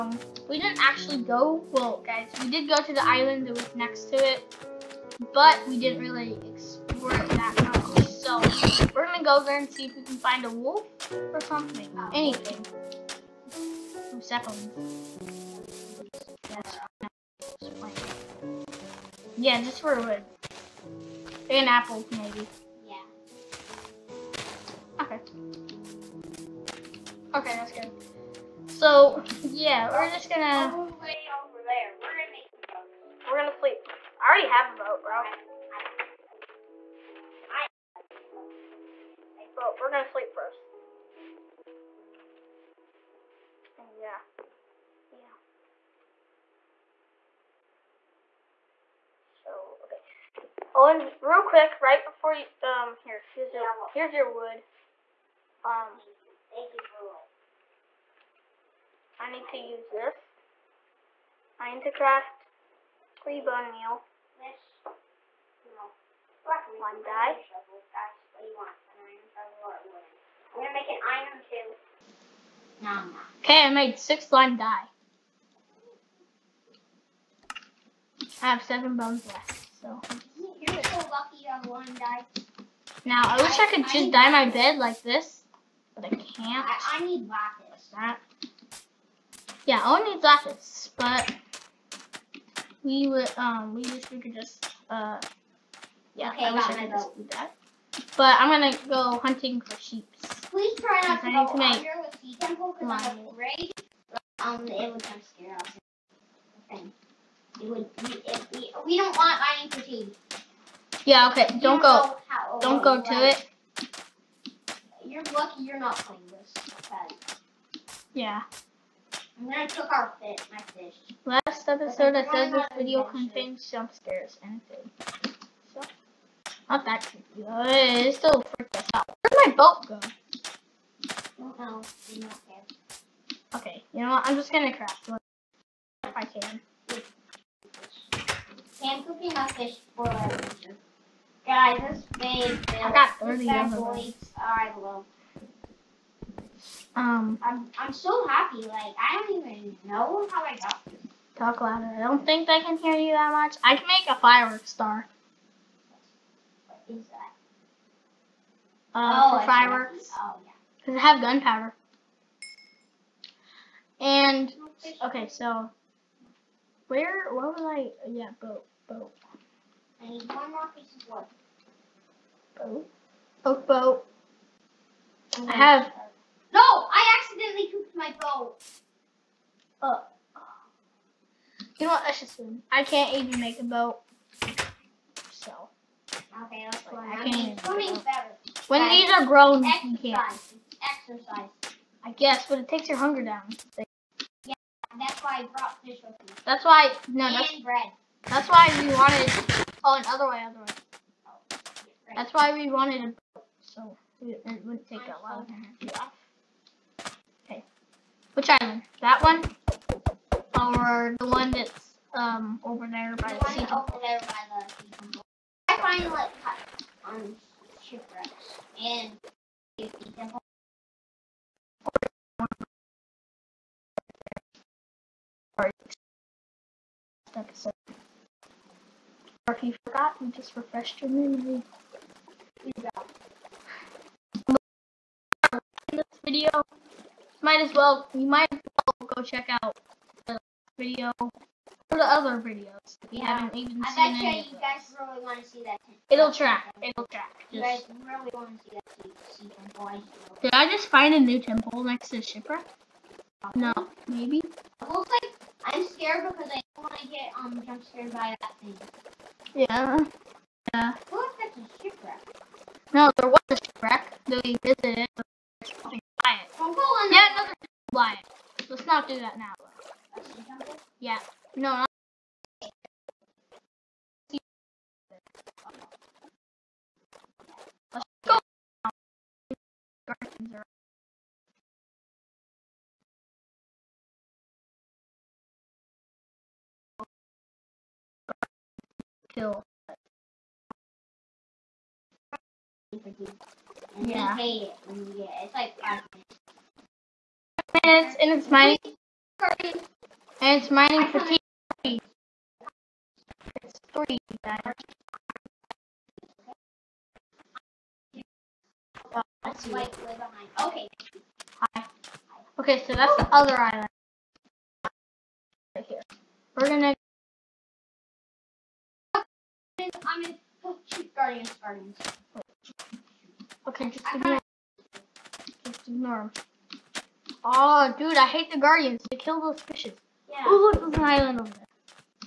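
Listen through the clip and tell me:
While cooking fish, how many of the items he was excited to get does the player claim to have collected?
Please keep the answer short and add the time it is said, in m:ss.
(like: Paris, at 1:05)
30, at 2:23.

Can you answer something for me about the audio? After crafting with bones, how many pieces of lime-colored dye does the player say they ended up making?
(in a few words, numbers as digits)
6.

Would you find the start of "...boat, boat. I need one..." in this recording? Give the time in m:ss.
2:48.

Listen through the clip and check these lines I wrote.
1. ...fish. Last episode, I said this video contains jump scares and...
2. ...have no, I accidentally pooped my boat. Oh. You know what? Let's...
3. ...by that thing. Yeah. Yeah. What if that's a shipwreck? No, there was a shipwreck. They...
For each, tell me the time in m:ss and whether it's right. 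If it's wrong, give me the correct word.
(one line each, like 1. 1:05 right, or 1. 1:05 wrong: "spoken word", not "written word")
1. 2:00 right
2. 2:55 right
3. 4:18 right.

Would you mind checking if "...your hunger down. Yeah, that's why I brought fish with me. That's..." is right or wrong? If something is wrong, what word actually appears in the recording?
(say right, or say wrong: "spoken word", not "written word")
right.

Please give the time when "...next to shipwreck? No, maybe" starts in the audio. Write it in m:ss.
4:11.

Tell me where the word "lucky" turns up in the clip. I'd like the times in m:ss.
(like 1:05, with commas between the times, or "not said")
1:20, 1:55.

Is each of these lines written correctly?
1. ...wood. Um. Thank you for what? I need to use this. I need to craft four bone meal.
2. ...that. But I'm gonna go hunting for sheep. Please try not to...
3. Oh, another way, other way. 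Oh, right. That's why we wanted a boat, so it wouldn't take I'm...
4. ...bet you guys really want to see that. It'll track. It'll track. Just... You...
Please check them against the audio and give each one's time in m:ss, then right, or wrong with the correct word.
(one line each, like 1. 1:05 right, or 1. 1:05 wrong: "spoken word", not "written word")
1. 0:54 wrong: "three", not "four"
2. 1:37 right
3. 3:19 right
4. 4:04 right.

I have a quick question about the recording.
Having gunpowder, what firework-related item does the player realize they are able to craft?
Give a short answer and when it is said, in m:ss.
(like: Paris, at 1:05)
Fireworks star, at 2:34.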